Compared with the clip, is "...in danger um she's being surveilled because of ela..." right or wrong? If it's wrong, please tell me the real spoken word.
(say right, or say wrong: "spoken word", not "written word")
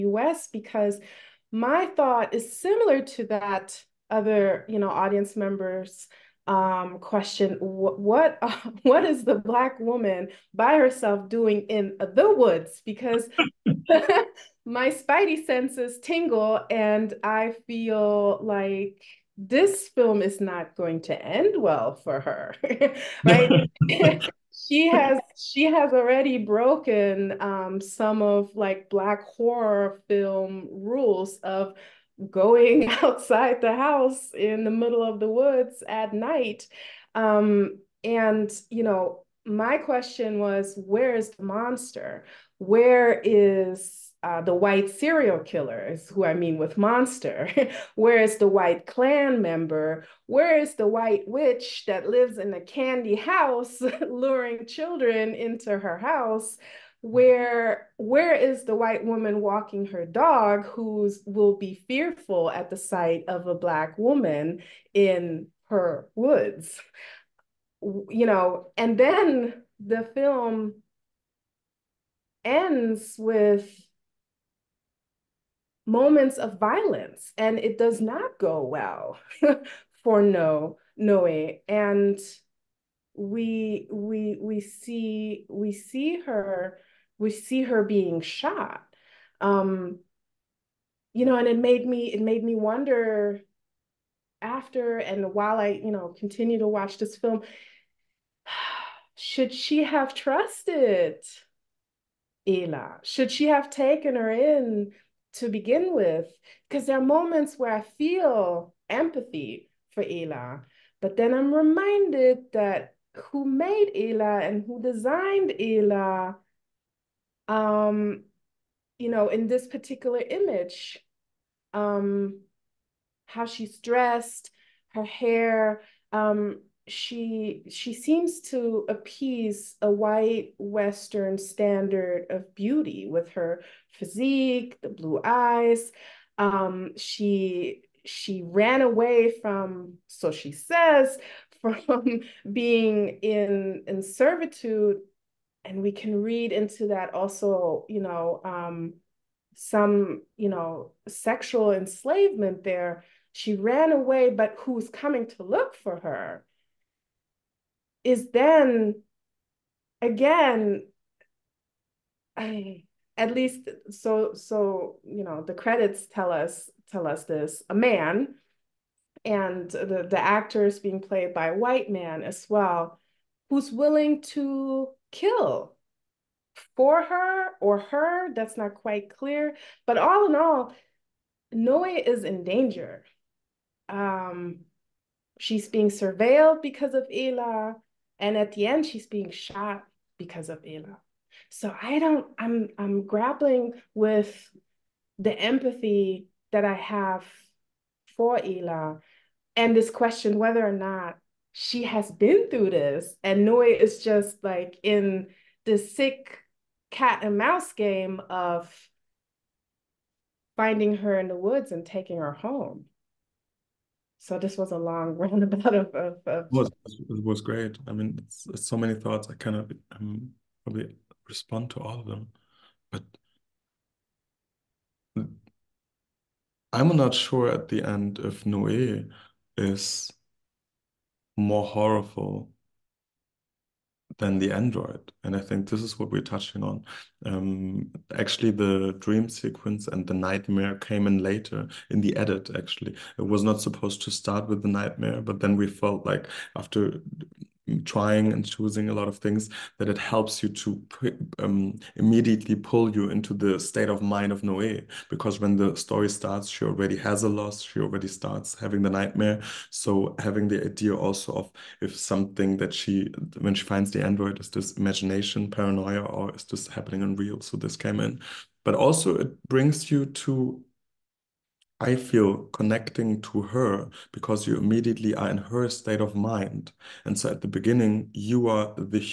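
right.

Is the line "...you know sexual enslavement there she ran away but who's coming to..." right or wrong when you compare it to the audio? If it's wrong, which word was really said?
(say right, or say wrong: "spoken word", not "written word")
right.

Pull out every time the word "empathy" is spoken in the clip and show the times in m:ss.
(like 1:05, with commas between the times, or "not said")
1:48, 3:15.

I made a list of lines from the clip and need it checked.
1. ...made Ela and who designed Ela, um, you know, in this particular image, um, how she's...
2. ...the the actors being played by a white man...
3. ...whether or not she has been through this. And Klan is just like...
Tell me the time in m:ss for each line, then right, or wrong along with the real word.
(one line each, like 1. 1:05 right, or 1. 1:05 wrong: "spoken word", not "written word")
1. 1:53 right
2. 2:49 right
3. 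3:20 wrong: "Noé", not "Klan".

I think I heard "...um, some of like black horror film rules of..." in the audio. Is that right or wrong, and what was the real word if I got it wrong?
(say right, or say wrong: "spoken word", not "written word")
right.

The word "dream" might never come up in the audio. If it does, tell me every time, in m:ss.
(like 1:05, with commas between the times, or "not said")
3:58.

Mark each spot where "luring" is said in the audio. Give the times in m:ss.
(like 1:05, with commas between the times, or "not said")
0:54.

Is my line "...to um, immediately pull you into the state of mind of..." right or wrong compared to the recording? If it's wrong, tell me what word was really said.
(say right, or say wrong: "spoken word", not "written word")
right.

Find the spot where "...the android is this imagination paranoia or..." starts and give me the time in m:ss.
4:23.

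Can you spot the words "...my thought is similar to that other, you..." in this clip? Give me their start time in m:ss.
0:01.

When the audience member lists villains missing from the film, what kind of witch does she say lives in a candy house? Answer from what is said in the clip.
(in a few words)
White witch.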